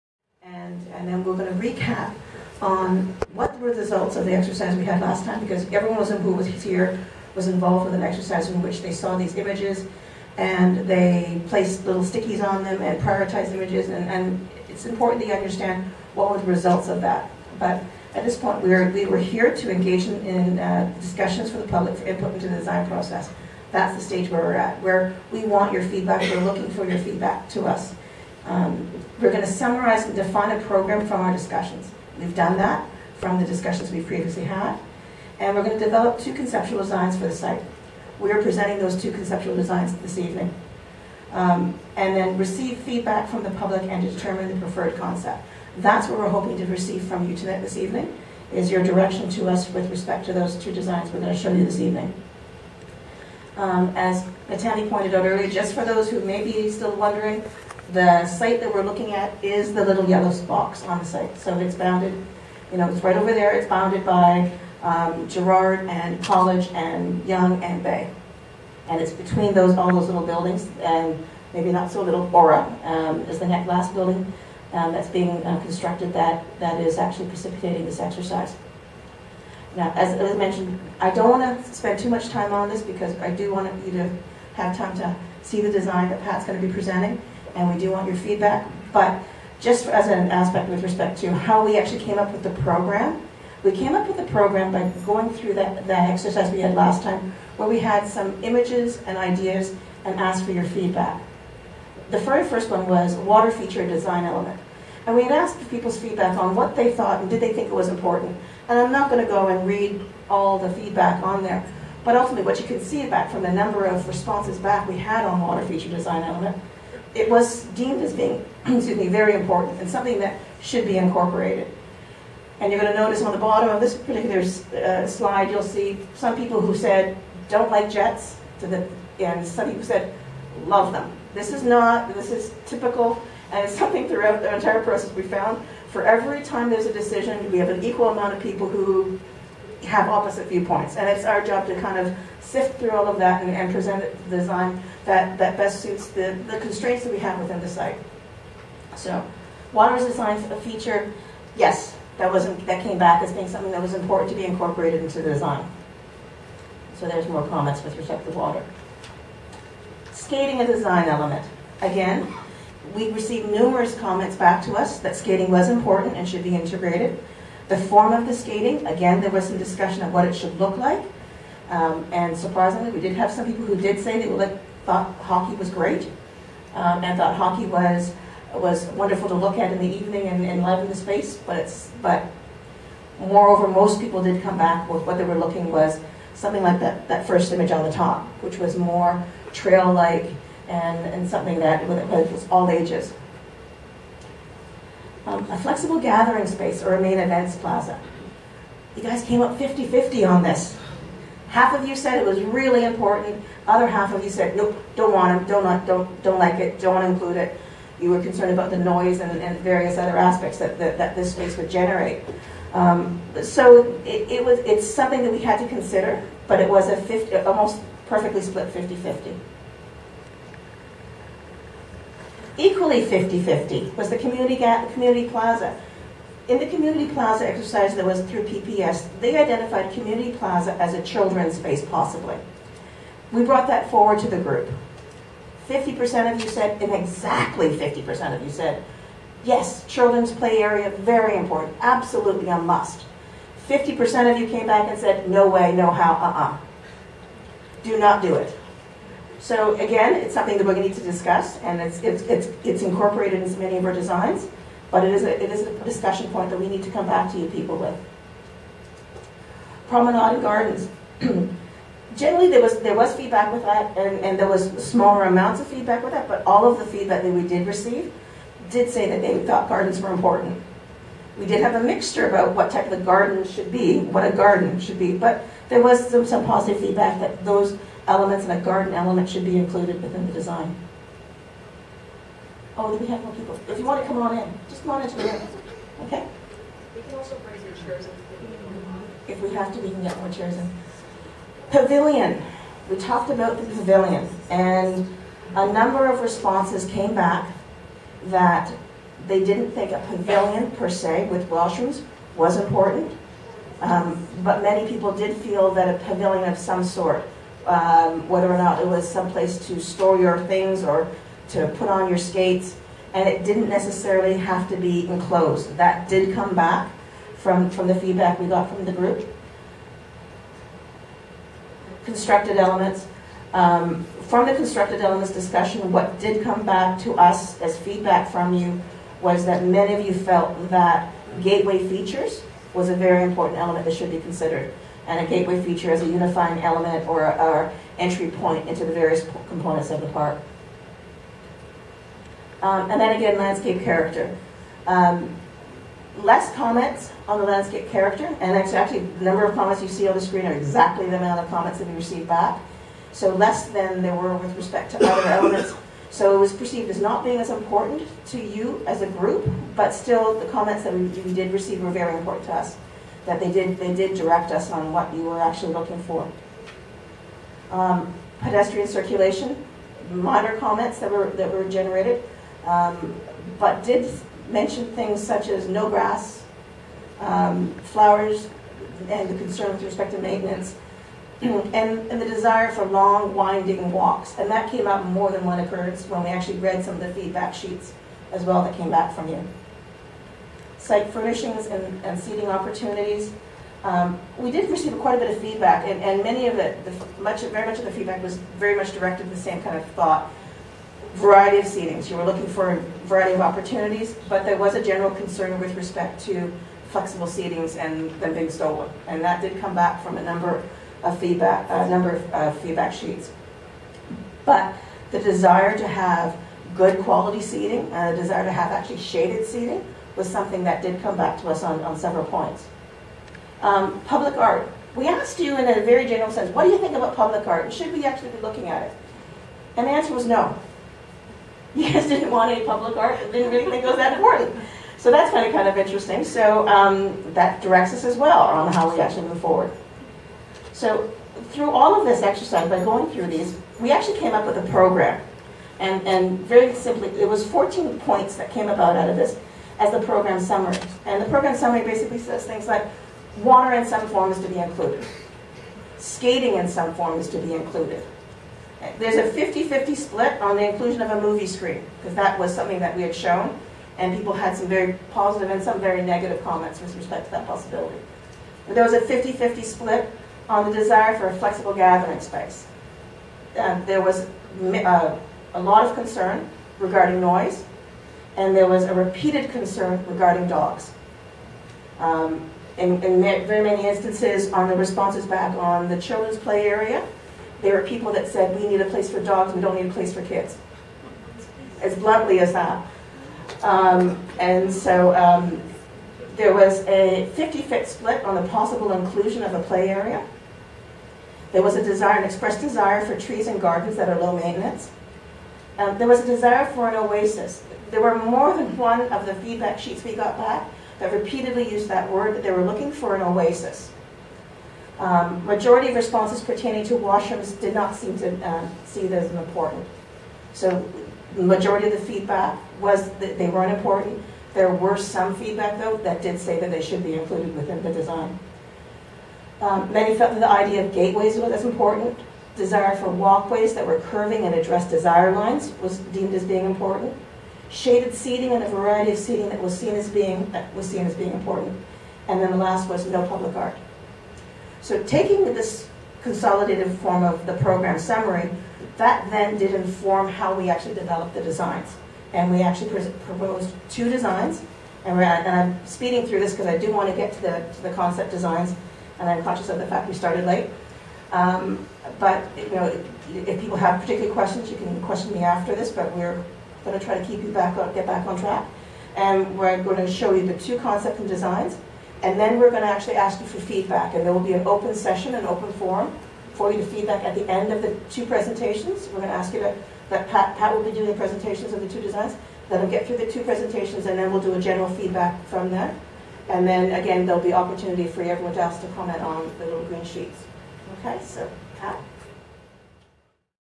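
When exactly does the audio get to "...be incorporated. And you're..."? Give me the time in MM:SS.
02:00.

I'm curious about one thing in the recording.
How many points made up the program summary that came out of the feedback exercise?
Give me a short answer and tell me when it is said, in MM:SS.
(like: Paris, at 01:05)
14, at 07:27.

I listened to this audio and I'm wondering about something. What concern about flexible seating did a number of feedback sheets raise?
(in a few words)
Being stolen.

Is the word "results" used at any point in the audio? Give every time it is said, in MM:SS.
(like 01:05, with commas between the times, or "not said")
00:03, 00:16.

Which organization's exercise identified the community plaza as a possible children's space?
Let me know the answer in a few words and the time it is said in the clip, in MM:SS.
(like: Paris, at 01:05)
PPS, at 03:48.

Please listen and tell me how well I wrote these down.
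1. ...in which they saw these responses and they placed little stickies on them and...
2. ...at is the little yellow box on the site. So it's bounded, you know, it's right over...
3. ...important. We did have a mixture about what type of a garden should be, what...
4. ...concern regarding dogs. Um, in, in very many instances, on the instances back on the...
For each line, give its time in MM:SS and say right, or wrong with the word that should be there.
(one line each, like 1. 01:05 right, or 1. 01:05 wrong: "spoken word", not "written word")
1. 00:08 wrong: "images", not "responses"
2. 00:59 right
3. 04:30 right
4. 07:59 wrong: "responses", not "instances".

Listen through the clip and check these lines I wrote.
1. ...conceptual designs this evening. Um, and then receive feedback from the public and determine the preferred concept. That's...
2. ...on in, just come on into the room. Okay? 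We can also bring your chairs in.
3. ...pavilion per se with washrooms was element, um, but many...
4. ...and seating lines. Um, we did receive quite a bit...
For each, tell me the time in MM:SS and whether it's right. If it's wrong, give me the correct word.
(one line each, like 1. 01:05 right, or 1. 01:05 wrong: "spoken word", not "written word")
1. 00:39 right
2. 04:44 right
3. 05:00 wrong: "important", not "element"
4. 06:32 wrong: "opportunities", not "lines".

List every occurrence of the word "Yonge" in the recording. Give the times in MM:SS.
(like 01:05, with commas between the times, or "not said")
01:07.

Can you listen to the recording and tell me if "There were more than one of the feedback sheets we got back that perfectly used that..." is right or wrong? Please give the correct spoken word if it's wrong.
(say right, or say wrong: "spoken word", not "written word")
wrong: "repeatedly", not "perfectly".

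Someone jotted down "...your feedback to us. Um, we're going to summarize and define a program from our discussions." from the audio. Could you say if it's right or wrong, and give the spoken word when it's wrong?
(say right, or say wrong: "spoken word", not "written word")
right.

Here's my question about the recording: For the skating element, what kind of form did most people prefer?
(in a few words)
Trail-like.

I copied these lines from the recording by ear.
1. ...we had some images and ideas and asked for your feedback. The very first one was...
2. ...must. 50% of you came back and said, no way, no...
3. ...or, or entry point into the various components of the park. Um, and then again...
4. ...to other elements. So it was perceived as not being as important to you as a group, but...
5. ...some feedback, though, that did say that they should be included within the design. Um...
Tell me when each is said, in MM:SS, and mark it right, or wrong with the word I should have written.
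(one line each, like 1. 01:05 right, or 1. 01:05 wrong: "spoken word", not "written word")
1. 01:37 right
2. 04:02 right
3. 05:37 right
4. 05:54 right
5. 08:44 right.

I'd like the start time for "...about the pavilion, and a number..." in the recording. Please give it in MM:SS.
04:53.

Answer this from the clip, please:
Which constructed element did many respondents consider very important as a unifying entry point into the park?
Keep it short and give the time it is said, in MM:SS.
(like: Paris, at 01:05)
Gateway features, at 05:31.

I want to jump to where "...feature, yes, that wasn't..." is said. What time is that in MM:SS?
02:30.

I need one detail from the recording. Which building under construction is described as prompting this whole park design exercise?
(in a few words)
Aura.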